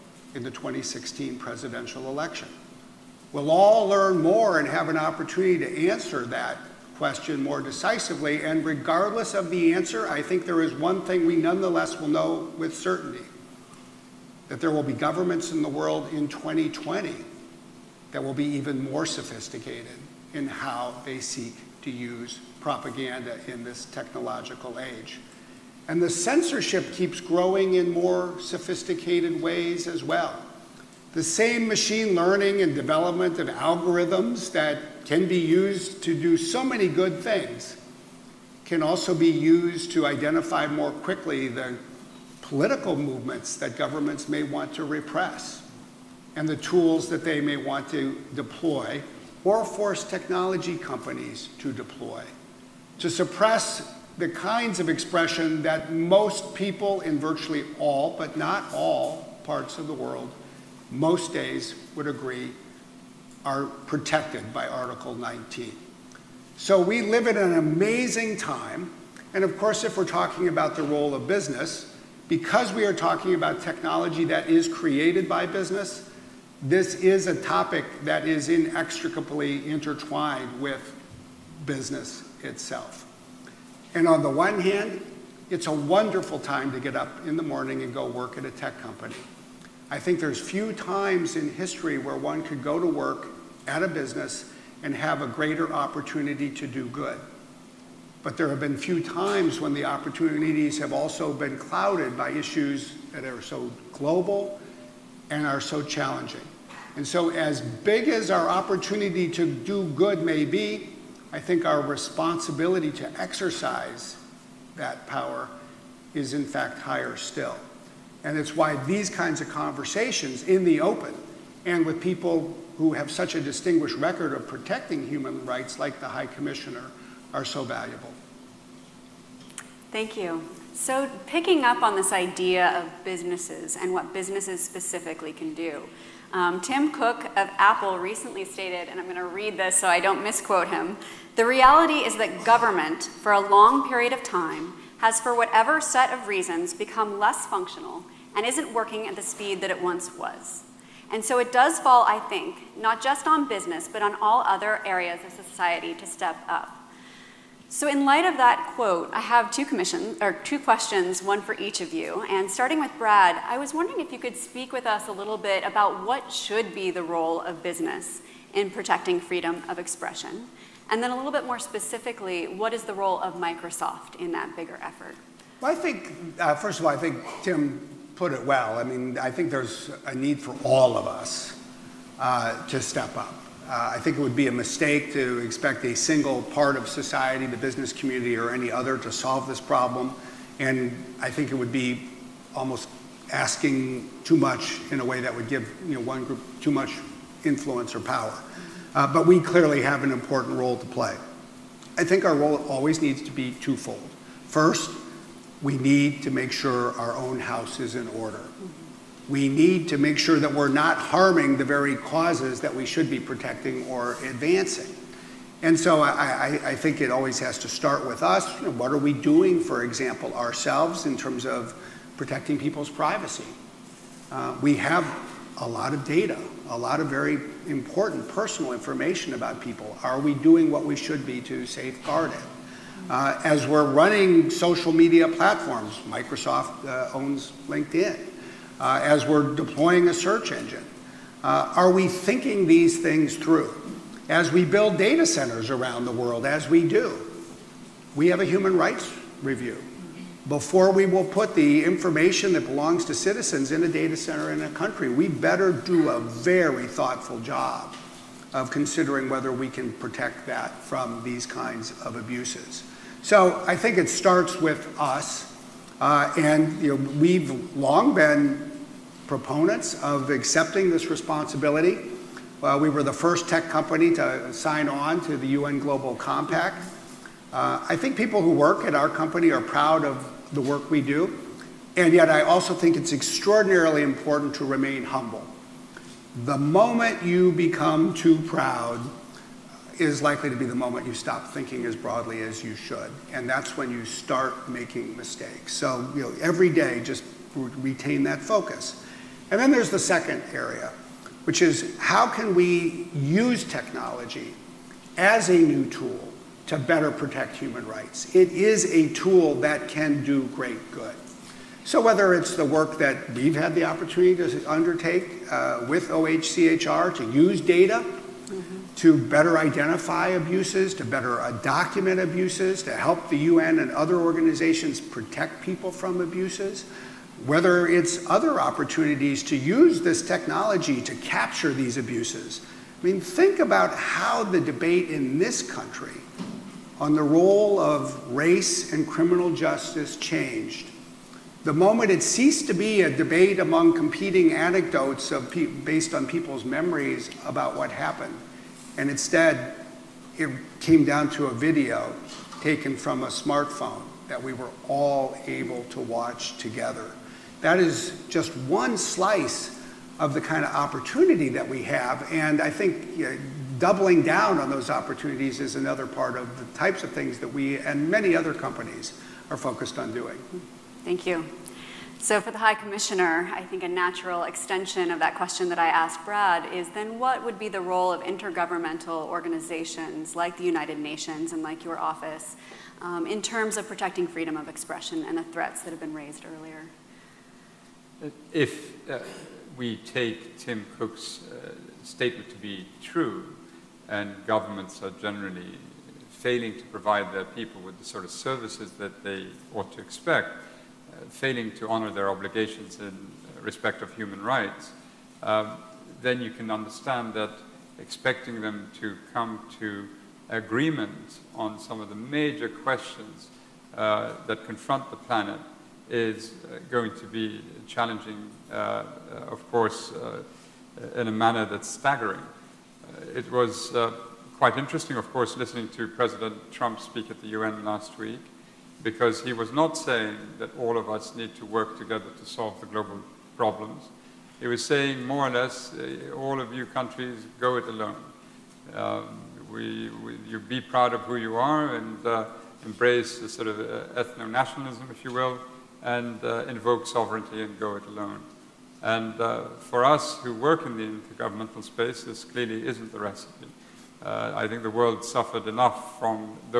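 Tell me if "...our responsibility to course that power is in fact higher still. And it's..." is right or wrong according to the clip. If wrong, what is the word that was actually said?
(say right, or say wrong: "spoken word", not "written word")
wrong: "exercise", not "course".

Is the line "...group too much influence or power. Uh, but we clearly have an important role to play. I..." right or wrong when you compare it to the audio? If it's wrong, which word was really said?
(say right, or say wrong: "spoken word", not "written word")
right.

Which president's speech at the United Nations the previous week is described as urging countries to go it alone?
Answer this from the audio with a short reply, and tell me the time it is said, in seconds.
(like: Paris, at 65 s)
President Trump, at 426 s.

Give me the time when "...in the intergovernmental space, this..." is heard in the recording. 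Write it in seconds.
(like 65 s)
450 s.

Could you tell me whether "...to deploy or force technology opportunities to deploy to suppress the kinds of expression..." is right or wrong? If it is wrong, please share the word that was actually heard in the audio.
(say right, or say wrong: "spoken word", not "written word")
wrong: "companies", not "opportunities".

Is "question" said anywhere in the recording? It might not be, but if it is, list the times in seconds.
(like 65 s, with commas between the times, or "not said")
6 s, 160 s, 375 s, 412 s.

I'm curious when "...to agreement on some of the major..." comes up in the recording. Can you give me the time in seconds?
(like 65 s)
409 s.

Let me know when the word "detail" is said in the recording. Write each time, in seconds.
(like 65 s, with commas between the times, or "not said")
not said.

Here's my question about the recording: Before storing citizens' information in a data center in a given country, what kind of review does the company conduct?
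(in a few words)
human rights review.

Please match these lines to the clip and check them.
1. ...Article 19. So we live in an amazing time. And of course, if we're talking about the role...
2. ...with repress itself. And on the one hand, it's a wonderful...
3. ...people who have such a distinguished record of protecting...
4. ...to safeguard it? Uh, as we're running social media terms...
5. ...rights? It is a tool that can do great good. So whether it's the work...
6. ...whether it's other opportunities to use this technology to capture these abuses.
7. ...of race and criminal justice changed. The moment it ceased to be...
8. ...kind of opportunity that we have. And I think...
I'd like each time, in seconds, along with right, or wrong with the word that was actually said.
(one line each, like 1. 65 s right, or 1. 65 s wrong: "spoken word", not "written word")
1. 64 s right
2. 80 s wrong: "business", not "repress"
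3. 122 s right
4. 231 s wrong: "platforms", not "terms"
5. 307 s right
6. 327 s right
7. 337 s right
8. 360 s right.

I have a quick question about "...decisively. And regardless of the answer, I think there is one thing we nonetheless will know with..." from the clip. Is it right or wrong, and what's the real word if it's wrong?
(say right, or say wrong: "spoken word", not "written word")
right.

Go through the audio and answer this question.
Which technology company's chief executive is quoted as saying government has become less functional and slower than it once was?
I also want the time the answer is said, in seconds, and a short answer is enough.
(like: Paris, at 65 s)
Apple, at 137 s.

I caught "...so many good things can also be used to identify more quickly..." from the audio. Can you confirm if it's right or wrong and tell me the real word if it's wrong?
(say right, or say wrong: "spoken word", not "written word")
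right.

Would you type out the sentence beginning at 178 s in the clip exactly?
I mean, I think there's a need for all of us uh, to step up.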